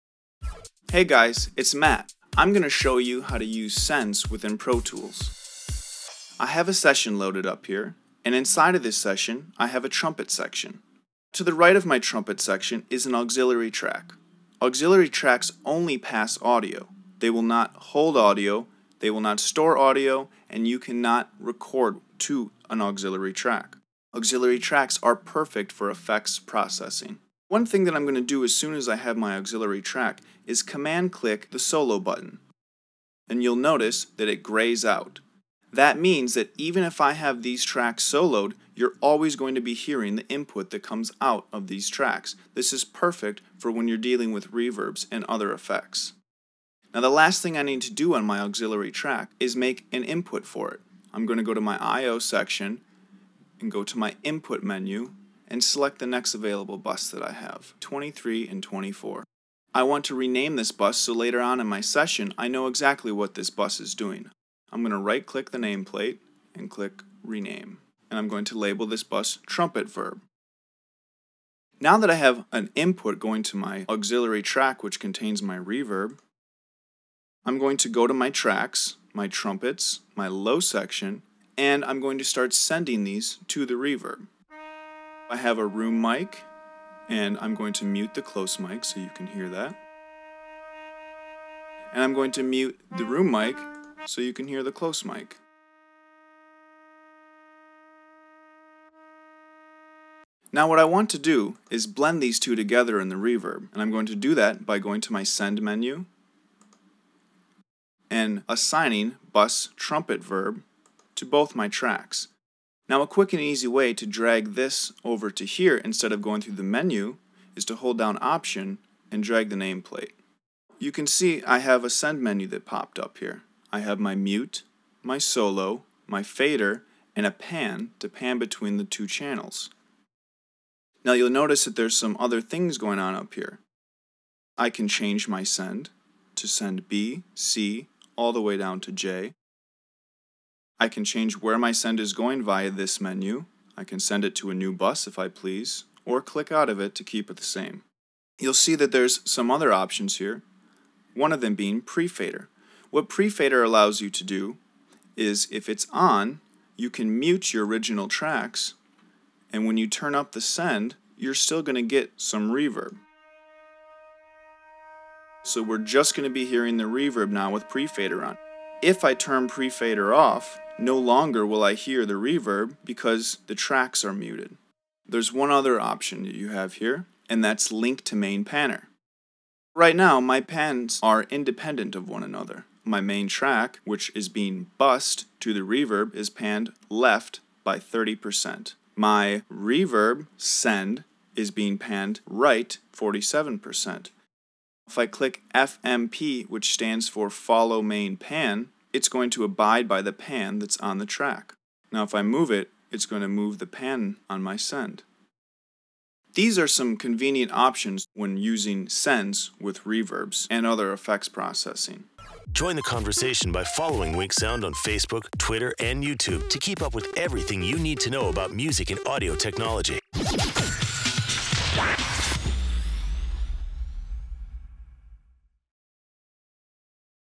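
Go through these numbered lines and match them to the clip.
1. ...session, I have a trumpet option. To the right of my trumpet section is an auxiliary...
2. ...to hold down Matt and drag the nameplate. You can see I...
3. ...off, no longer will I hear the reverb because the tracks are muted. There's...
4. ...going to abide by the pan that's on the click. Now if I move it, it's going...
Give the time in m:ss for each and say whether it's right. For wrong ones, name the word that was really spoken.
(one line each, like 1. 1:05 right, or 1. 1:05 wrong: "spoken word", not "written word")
1. 0:08 wrong: "section", not "option"
2. 1:57 wrong: "Option", not "Matt"
3. 2:50 right
4. 3:19 wrong: "track", not "click".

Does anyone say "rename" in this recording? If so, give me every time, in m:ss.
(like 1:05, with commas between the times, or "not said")
1:00, 1:07.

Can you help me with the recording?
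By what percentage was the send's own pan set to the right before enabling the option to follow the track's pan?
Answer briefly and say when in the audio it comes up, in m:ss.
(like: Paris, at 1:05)
47%, at 3:12.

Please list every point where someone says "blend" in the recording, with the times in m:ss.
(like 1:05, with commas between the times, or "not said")
1:41.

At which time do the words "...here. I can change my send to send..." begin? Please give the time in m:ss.
2:13.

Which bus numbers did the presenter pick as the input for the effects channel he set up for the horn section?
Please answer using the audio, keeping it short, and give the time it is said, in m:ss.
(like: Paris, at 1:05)
23 and 24, at 0:57.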